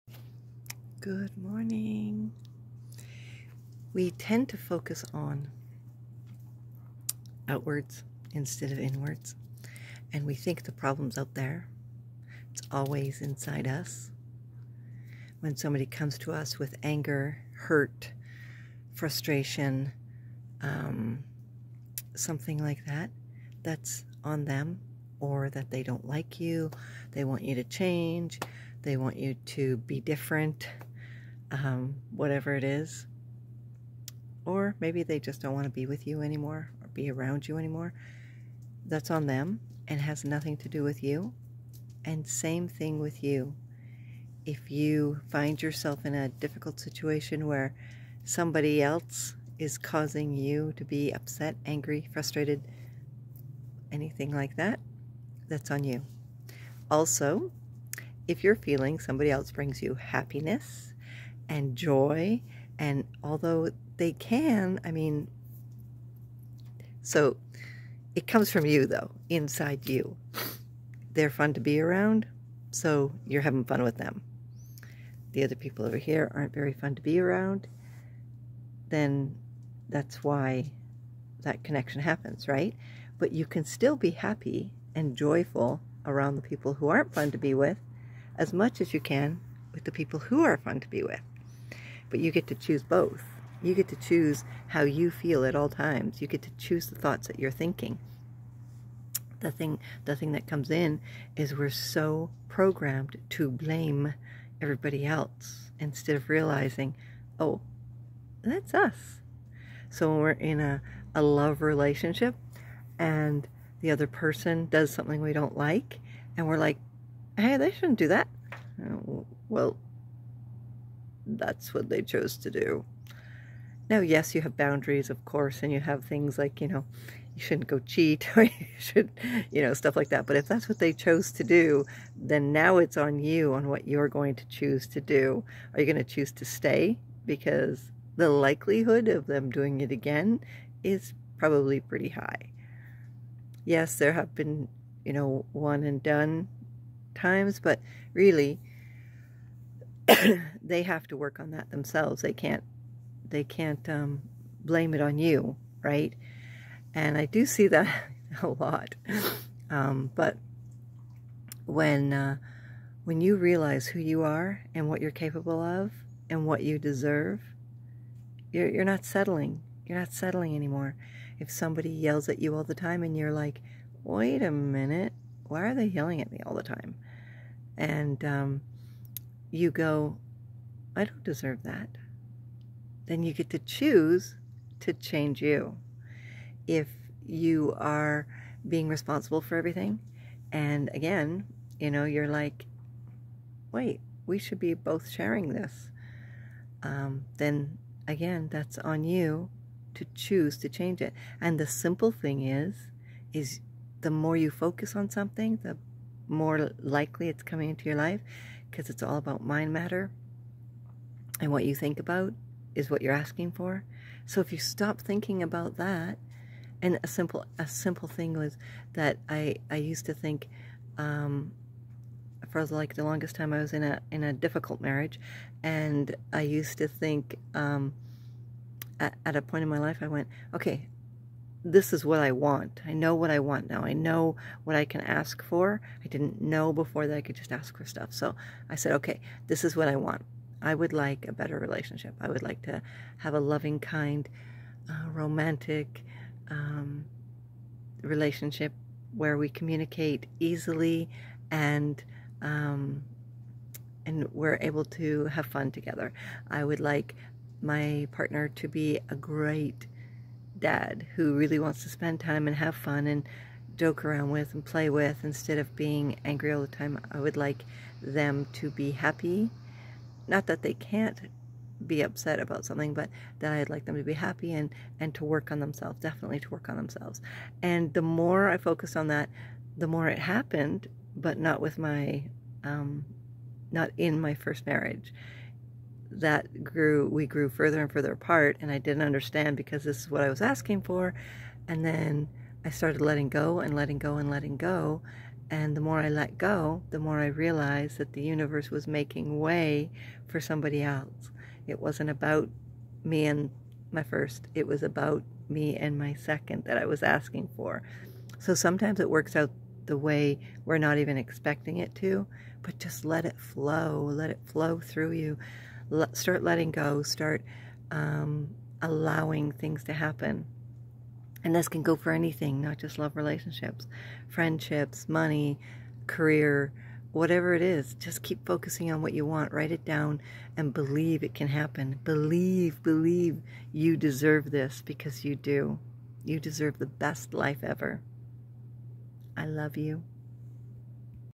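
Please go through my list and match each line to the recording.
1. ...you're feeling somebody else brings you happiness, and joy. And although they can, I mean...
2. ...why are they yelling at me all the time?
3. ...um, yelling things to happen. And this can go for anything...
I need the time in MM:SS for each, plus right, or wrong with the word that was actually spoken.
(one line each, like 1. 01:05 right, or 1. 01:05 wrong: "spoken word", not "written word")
1. 00:58 right
2. 02:55 right
3. 05:17 wrong: "allowing", not "yelling".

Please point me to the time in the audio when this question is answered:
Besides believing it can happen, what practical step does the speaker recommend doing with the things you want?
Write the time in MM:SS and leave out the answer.
05:29.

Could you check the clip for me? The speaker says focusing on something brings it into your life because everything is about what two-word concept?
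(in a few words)
Mind matter.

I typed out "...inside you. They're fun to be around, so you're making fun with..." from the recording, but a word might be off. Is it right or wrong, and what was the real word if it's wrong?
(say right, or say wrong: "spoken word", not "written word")
wrong: "having", not "making".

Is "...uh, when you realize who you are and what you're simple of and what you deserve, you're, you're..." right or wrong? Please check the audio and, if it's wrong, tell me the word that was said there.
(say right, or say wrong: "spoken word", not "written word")
wrong: "capable", not "simple".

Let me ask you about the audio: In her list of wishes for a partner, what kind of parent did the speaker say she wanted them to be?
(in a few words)
A great dad.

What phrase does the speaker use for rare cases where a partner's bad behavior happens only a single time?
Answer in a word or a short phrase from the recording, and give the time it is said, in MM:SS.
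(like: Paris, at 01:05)
One and done, at 02:25.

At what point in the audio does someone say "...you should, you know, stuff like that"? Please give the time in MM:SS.
02:08.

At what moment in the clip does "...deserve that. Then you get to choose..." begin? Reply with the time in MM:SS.
03:01.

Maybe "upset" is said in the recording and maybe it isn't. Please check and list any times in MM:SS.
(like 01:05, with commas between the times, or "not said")
00:51, 04:32.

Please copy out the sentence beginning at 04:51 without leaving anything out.
And then I started letting go and letting go and letting go.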